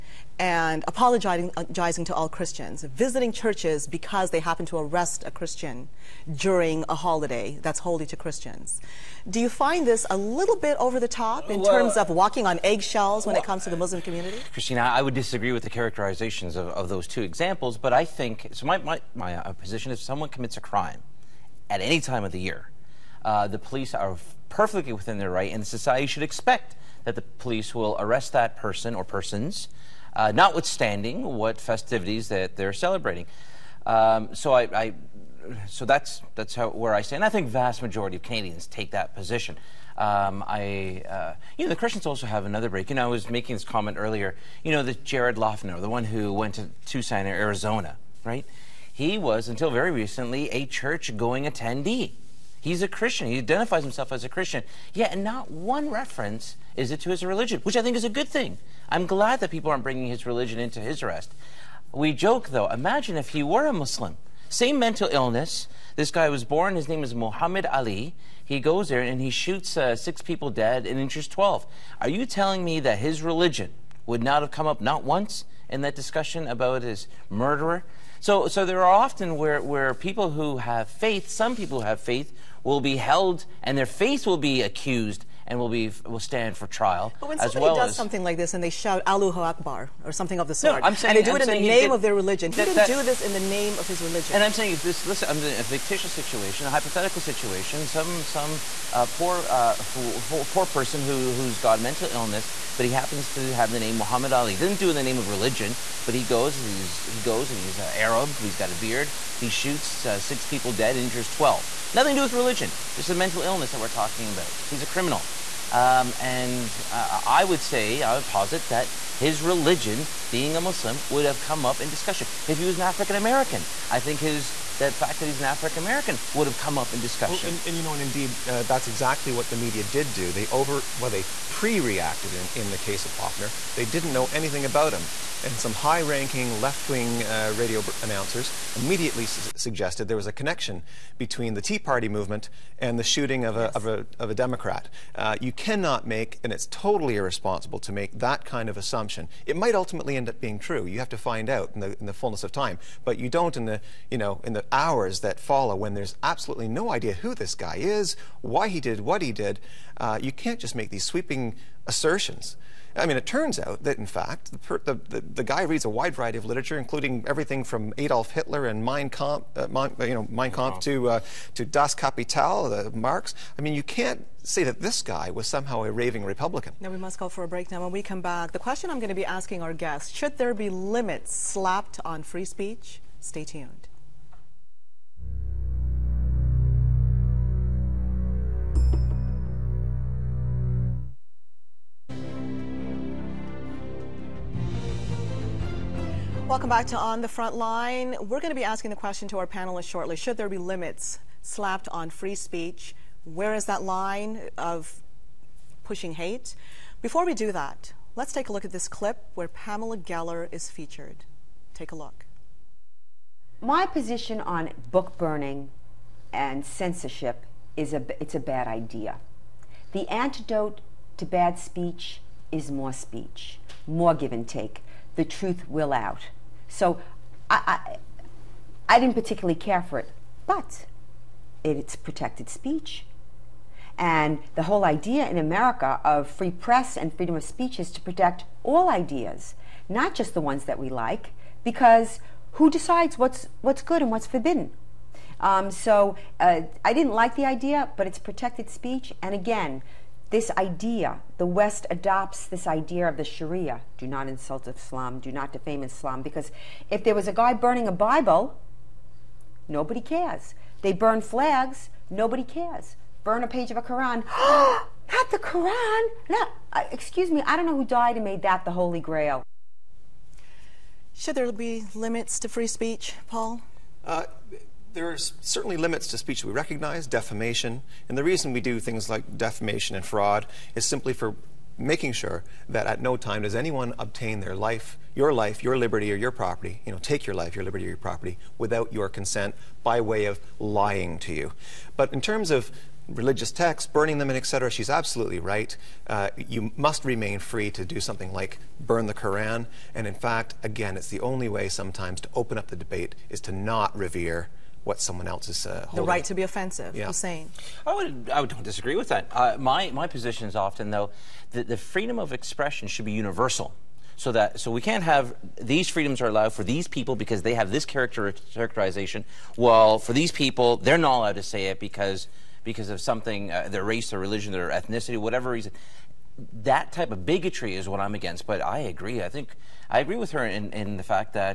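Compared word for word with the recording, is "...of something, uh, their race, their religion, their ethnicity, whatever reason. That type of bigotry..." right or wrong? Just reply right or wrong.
right.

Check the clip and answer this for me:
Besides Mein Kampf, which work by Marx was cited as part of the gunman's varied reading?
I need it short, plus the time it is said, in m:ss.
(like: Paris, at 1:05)
Das Kapital, at 2:51.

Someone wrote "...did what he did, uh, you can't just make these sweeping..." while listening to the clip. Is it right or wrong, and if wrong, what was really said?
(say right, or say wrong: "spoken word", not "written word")
right.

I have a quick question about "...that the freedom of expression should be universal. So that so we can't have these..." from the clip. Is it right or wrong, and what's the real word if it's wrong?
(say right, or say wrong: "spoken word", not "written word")
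right.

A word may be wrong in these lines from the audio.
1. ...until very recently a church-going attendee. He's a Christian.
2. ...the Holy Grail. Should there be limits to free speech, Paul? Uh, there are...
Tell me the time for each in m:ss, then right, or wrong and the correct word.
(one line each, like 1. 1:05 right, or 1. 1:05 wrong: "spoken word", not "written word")
1. 0:49 right
2. 4:28 right.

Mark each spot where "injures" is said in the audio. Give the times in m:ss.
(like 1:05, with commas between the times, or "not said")
1:10, 1:50.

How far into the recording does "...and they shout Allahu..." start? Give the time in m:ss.
1:28.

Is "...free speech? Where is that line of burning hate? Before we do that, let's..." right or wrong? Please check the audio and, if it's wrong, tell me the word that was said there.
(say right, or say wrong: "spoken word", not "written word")
wrong: "pushing", not "burning".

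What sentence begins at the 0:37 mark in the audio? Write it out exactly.
I think vast majority of Canadians take that position.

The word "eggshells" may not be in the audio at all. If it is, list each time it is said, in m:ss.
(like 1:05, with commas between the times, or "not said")
0:12.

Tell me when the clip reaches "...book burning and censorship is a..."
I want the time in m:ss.
3:34.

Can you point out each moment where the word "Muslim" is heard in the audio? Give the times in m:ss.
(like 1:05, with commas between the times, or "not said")
0:13, 1:03, 2:00.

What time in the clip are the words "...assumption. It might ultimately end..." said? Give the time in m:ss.
2:28.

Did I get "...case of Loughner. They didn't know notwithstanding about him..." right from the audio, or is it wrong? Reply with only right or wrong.
wrong.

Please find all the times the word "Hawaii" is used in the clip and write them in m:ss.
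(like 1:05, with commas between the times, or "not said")
not said.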